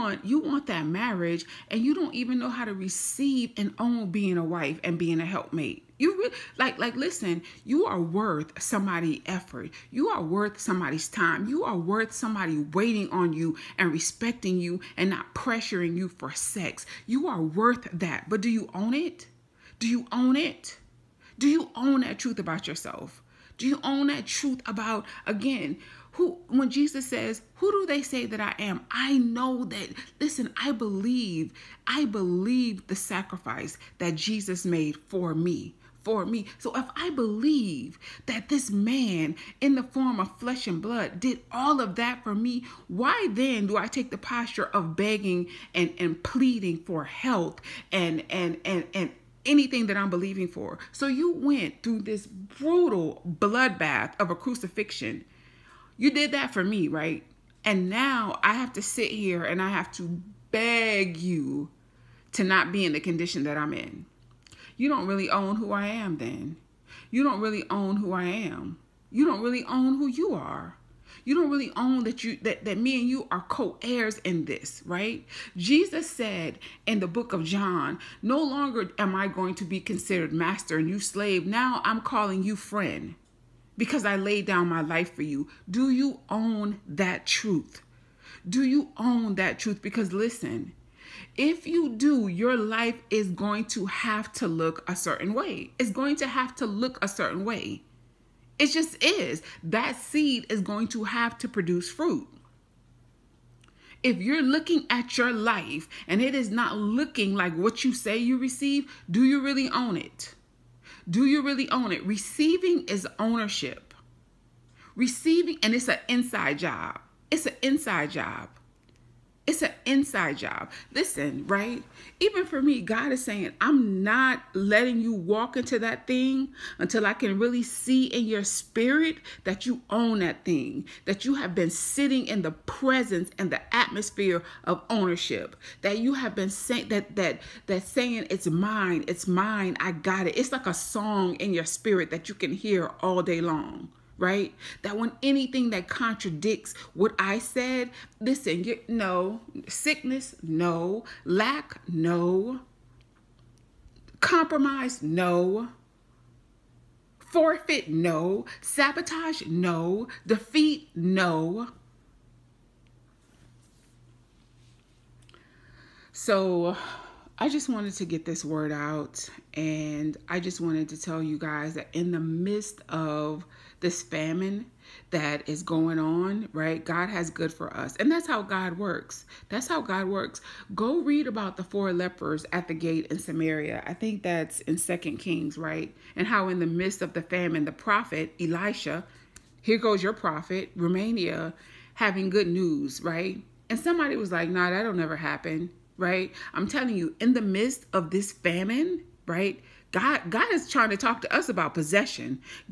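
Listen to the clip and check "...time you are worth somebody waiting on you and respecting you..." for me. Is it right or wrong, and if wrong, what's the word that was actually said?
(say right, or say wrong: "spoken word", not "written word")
right.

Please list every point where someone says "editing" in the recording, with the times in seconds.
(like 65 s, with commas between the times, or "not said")
not said.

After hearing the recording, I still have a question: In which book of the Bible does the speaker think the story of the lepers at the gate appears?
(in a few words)
Second Kings.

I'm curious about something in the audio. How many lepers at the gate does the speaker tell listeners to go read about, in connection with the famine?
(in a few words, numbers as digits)
4.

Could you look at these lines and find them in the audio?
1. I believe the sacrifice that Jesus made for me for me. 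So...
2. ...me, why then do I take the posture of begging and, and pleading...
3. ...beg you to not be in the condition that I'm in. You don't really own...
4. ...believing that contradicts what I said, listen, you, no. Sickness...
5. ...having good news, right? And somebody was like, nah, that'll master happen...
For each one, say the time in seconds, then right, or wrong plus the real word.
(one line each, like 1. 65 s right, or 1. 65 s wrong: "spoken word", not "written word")
1. 31 s right
2. 42 s right
3. 60 s right
4. 145 s wrong: "anything", not "believing"
5. 191 s wrong: "never", not "master".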